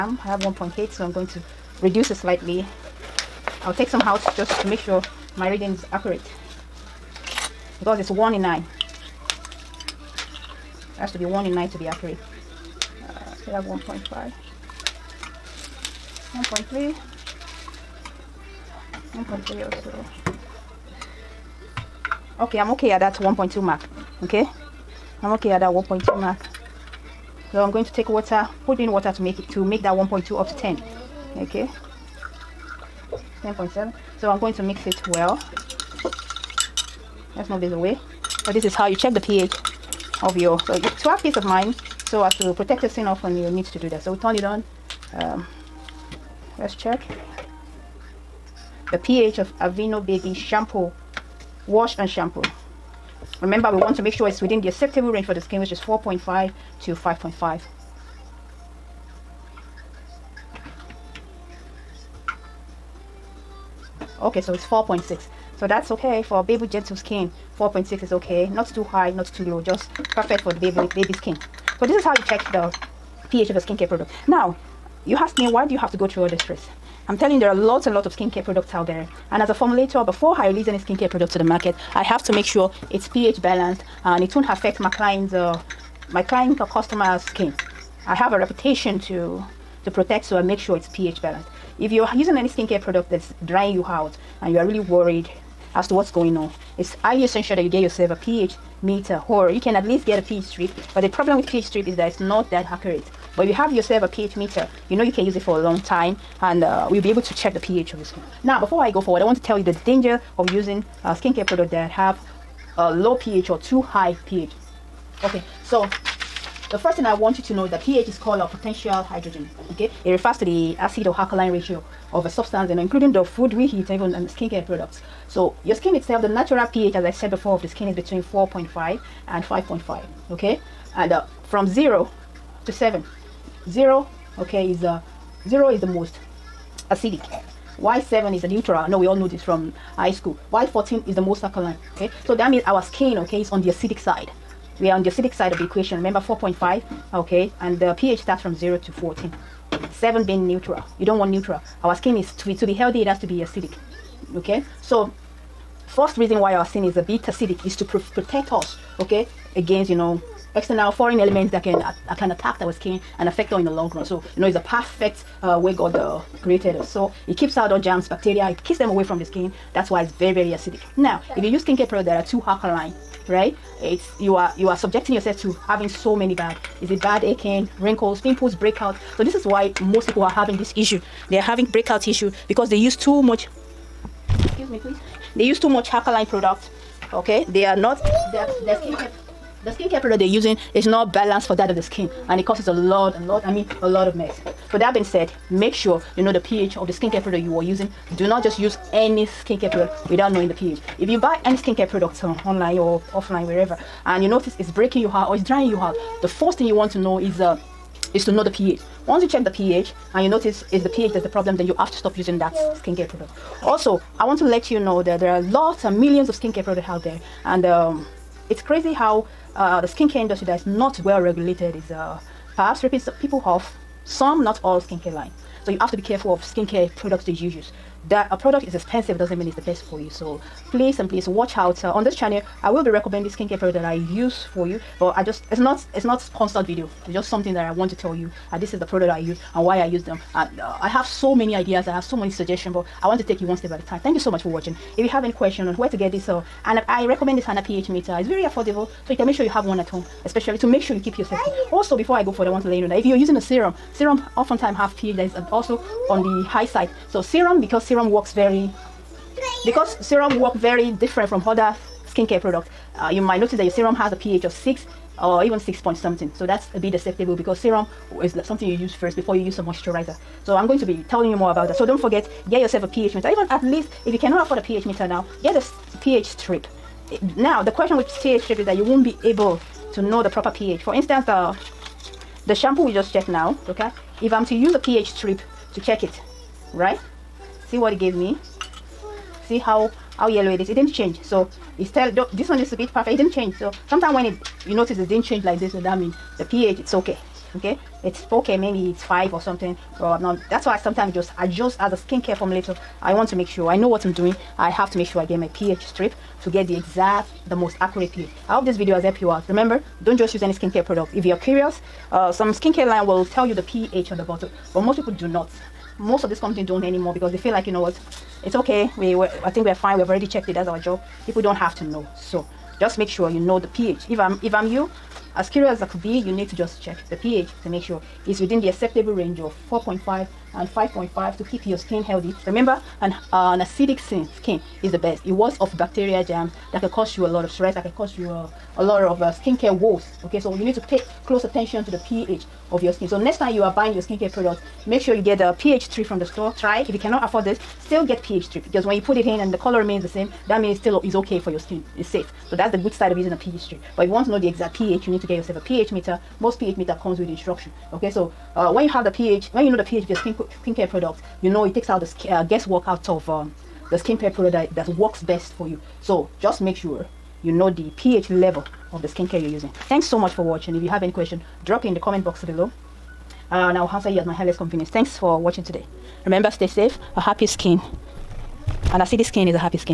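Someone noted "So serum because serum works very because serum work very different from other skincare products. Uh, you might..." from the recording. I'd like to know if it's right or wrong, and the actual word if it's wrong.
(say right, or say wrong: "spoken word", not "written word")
right.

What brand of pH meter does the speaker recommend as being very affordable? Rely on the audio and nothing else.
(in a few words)
Hanna.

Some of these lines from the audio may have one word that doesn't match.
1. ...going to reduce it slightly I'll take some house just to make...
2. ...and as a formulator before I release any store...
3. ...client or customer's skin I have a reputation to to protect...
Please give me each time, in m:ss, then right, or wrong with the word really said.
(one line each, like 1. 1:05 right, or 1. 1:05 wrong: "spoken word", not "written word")
1. 0:01 right
2. 1:19 wrong: "skincare", not "store"
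3. 1:26 right.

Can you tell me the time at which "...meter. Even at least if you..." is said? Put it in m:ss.
4:33.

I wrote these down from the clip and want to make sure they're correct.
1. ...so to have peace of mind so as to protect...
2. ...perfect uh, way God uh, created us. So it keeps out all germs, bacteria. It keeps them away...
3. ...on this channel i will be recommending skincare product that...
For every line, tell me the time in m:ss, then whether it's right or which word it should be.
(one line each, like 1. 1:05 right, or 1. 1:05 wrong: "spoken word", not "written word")
1. 0:40 right
2. 2:44 right
3. 3:51 right.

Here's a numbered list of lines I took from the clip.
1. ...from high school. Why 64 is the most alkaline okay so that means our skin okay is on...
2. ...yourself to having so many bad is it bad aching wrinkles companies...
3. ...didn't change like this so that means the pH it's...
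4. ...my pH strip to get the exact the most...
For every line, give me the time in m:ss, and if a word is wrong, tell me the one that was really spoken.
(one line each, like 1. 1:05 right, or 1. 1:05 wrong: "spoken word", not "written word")
1. 2:19 wrong: "14", not "64"
2. 2:55 wrong: "pimples", not "companies"
3. 4:55 right
4. 5:05 right.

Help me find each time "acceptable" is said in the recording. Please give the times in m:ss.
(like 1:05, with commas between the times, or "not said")
0:54, 4:26, 5:28.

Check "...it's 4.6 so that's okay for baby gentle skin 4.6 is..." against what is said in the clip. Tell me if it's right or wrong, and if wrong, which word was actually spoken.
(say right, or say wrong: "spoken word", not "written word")
right.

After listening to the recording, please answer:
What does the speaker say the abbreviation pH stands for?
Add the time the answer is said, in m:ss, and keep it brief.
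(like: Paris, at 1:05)
potential hydrogen, at 1:58.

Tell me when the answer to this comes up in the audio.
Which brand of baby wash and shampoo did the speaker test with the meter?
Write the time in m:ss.
0:49.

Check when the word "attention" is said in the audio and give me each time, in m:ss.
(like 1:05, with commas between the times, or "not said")
5:41.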